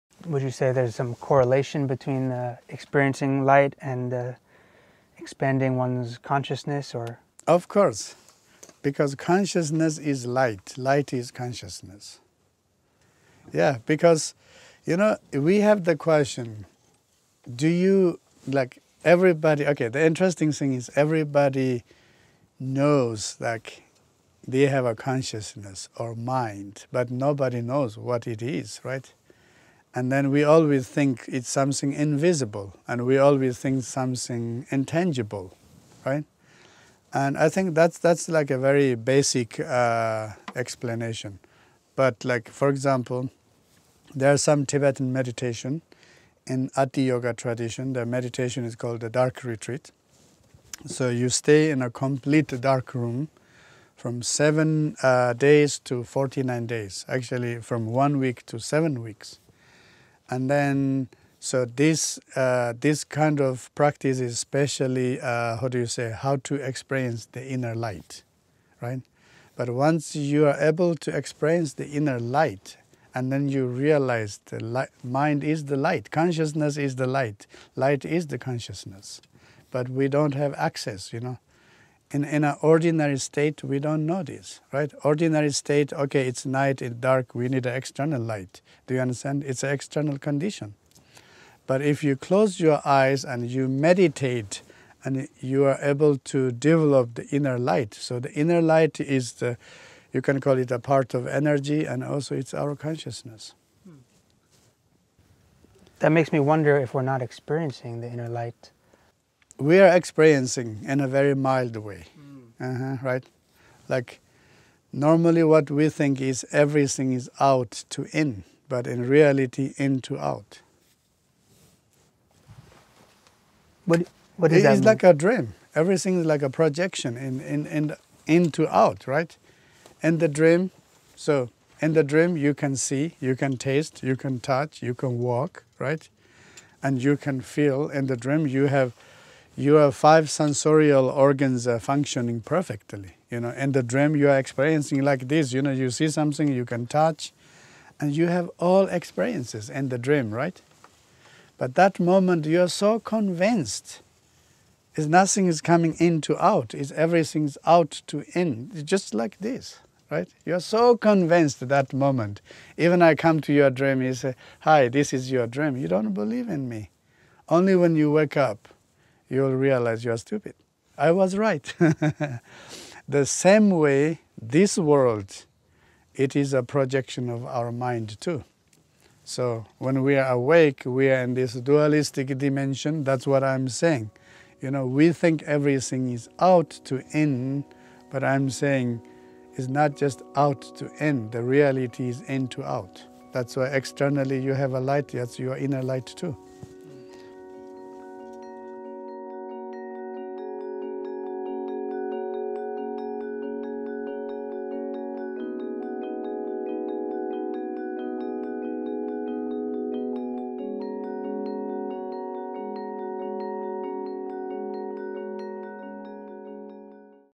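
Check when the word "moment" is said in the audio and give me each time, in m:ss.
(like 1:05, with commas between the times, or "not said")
2:31, 2:41.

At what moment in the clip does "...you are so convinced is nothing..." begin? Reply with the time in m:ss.
2:32.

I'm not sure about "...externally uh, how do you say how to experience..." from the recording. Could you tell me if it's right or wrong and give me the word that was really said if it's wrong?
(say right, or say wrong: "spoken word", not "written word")
wrong: "especially", not "externally".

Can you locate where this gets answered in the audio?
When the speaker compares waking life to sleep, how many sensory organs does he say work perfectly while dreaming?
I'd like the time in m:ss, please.
2:19.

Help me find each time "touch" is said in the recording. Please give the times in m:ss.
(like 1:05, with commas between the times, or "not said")
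2:14, 2:26.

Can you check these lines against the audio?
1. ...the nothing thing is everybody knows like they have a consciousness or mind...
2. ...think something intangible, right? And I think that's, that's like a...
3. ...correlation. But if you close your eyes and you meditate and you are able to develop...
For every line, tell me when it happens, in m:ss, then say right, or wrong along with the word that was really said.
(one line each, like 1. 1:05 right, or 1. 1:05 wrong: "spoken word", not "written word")
1. 0:19 wrong: "interesting", not "nothing"
2. 0:33 right
3. 1:30 wrong: "condition", not "correlation".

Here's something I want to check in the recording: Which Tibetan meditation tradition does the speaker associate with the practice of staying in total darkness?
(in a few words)
Ati Yoga.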